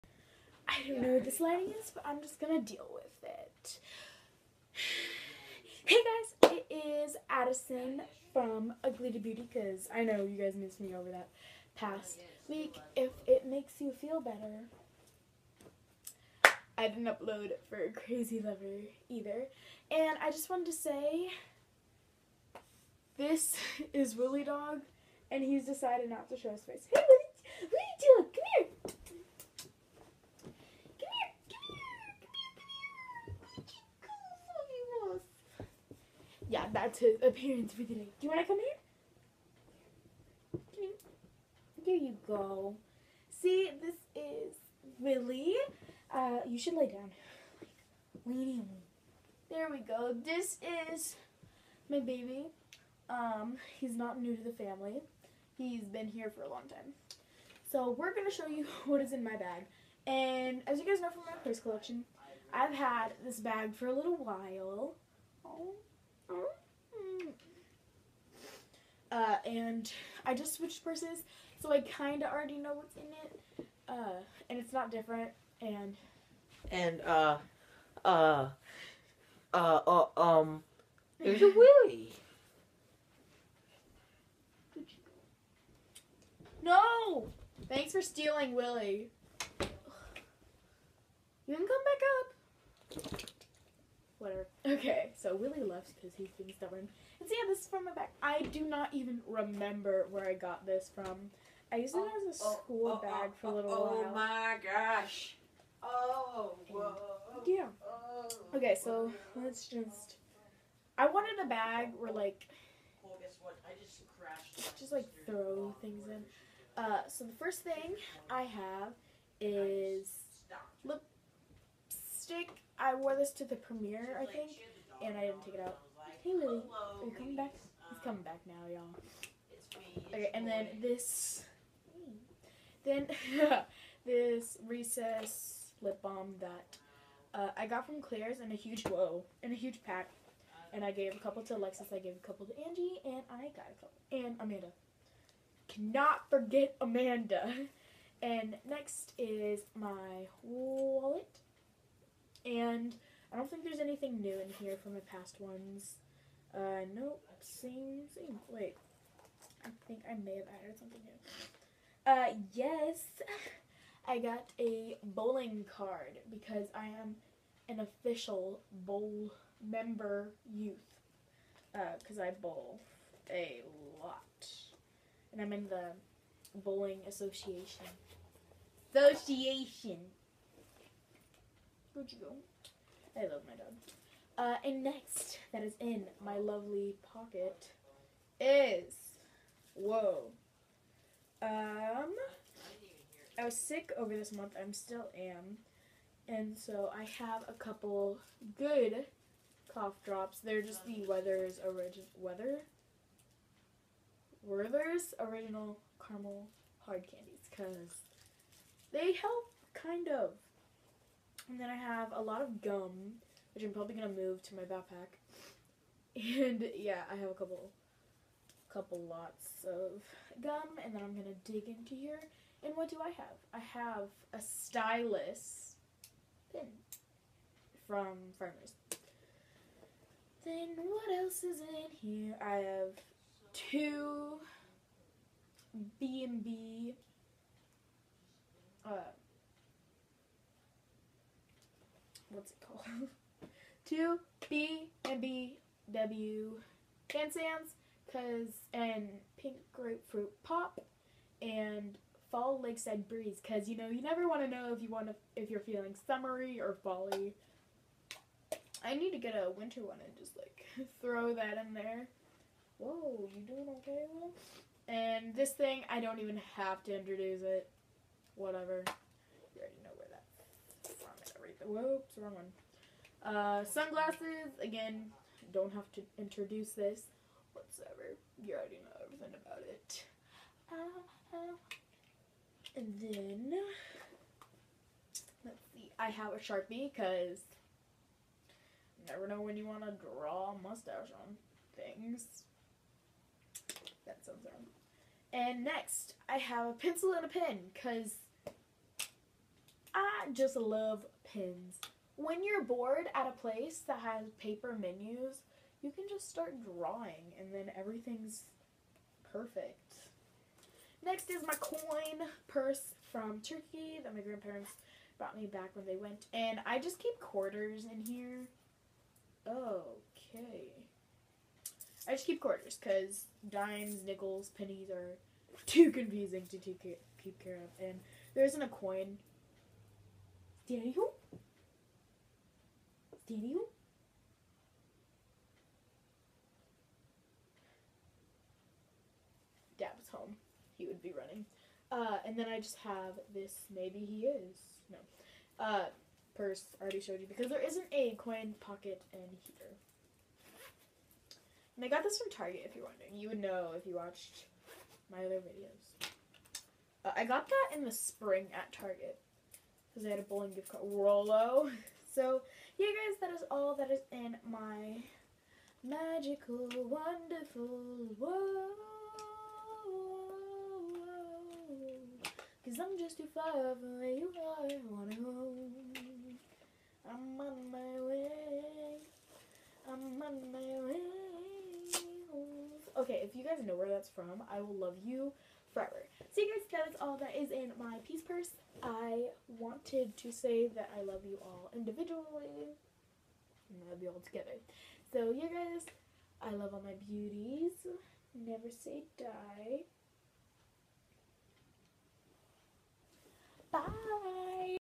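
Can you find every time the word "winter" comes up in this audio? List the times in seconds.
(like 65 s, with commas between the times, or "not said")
259 s.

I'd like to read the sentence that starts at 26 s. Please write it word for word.
Hey, Willy, Willy Dog, come here.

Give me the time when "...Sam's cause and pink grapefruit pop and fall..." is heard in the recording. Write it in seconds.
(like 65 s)
247 s.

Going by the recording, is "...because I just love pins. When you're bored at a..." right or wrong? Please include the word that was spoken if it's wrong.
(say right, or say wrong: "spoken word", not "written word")
right.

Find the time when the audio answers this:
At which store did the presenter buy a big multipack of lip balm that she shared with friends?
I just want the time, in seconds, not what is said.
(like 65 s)
138 s.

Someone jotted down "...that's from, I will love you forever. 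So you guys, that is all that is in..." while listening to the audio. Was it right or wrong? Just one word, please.
right.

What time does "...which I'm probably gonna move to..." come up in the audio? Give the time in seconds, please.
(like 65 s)
213 s.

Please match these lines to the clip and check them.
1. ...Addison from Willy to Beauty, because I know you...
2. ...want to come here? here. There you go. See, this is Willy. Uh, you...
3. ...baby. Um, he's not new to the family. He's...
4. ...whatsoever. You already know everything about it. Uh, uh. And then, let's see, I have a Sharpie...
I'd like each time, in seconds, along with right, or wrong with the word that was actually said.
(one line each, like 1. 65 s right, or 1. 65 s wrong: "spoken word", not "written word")
1. 7 s wrong: "Ugly", not "Willy"
2. 38 s right
3. 52 s right
4. 277 s right.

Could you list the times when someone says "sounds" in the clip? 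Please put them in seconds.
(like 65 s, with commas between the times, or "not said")
294 s.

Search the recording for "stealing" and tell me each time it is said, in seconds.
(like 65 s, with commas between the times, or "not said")
88 s.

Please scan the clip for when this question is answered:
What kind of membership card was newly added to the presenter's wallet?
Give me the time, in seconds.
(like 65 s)
165 s.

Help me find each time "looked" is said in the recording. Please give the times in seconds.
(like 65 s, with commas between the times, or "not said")
not said.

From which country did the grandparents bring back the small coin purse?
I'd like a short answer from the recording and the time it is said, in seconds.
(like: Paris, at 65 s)
Turkey, at 313 s.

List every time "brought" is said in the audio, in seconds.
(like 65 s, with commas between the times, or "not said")
315 s.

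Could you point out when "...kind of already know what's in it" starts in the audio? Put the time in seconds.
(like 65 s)
71 s.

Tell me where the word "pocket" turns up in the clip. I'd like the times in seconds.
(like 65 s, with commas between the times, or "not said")
187 s, 348 s.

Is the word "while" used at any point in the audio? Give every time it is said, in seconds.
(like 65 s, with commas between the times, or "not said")
64 s, 103 s.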